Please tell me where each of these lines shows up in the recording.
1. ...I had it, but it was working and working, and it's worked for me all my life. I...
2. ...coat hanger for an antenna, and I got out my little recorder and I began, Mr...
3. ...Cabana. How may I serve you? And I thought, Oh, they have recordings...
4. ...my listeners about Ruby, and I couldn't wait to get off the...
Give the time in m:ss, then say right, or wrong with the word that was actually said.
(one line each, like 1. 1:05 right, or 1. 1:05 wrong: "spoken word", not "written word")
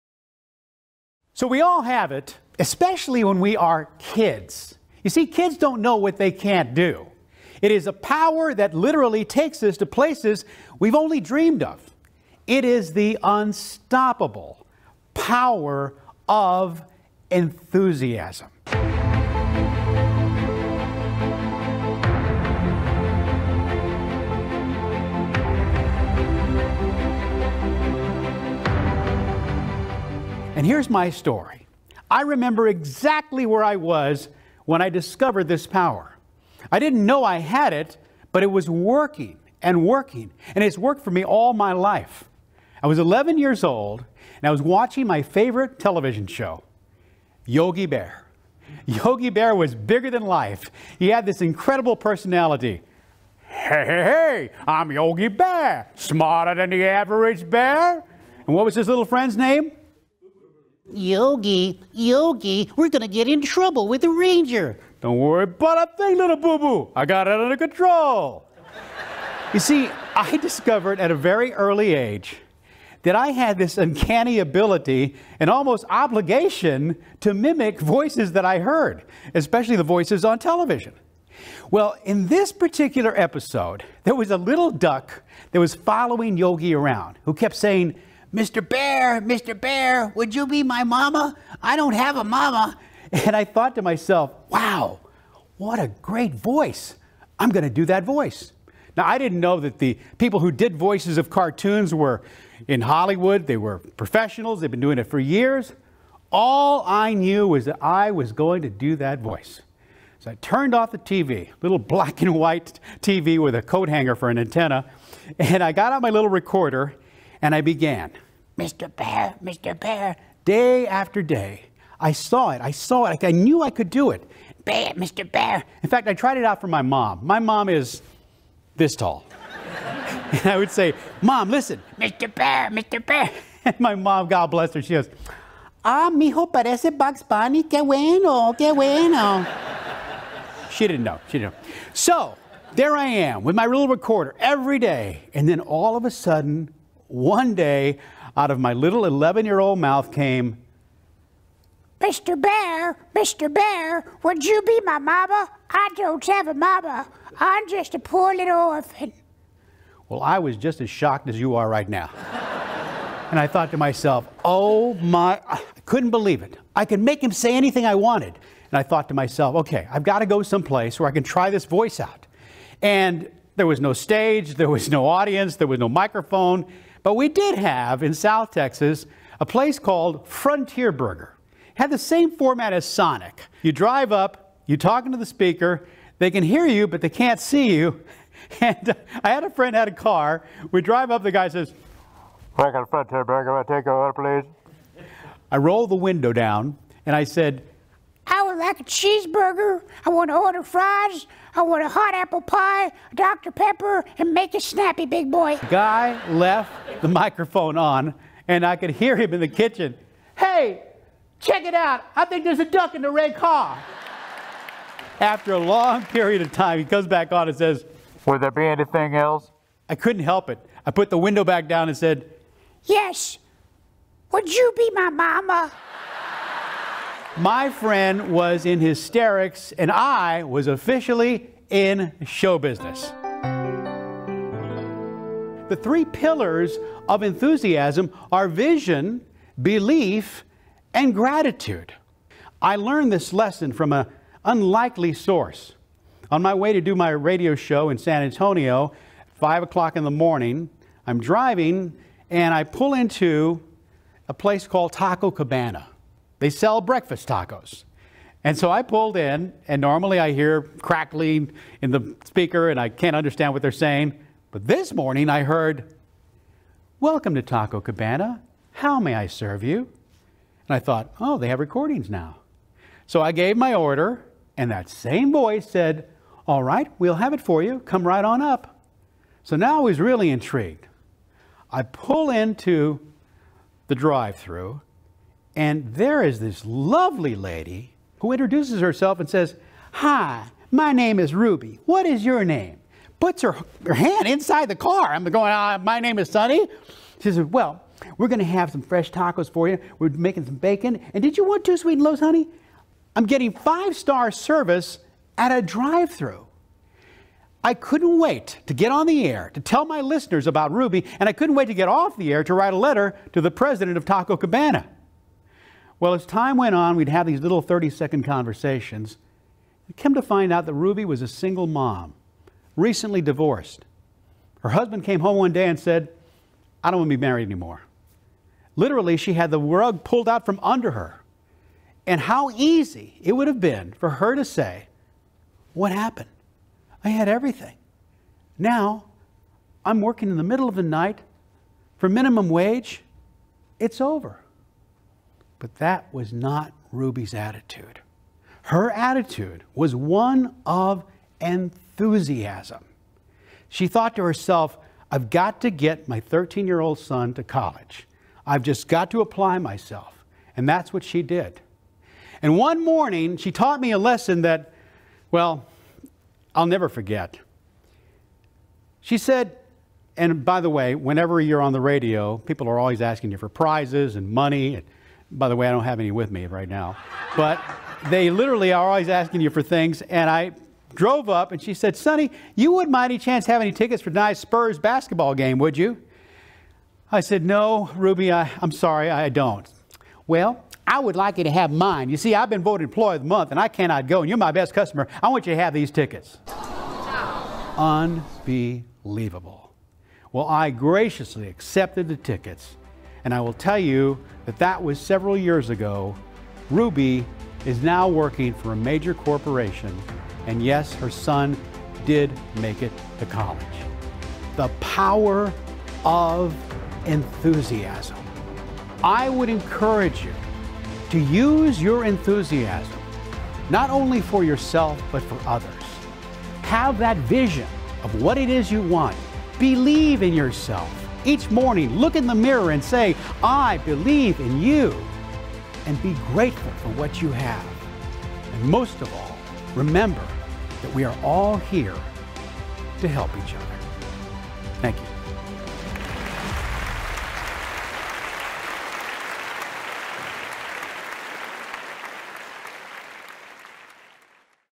1. 0:37 right
2. 1:53 right
3. 4:27 right
4. 5:09 right.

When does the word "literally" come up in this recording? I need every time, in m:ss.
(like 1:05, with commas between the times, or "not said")
0:08, 5:28, 6:18.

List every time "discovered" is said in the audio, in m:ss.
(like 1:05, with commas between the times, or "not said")
0:34, 1:10.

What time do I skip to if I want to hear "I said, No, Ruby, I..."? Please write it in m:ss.
6:27.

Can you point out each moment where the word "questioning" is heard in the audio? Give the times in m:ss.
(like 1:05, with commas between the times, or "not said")
not said.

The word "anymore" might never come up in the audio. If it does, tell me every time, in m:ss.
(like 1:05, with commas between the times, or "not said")
5:27.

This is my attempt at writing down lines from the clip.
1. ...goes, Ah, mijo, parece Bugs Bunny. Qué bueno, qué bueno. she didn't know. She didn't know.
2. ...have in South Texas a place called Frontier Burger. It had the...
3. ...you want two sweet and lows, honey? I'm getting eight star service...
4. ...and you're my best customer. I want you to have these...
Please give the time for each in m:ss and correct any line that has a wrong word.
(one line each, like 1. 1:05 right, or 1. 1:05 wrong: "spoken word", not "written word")
1. 2:14 right
2. 2:57 right
3. 5:01 wrong: "five", not "eight"
4. 6:34 right.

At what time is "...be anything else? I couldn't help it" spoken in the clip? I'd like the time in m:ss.
3:38.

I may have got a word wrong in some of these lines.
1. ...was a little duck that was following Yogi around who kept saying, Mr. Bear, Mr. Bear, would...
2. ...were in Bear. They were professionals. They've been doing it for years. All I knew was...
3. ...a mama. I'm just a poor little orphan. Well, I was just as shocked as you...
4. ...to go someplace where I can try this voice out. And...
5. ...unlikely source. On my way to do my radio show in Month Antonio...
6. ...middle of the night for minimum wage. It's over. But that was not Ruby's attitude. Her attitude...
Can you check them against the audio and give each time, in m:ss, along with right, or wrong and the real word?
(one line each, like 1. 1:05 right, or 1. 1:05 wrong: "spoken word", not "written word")
1. 1:24 right
2. 1:41 wrong: "Hollywood", not "Bear"
3. 2:36 right
4. 2:50 right
5. 4:04 wrong: "San", not "Month"
6. 5:40 right.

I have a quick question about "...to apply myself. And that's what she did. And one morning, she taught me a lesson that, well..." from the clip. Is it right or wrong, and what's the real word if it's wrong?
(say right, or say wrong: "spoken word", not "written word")
right.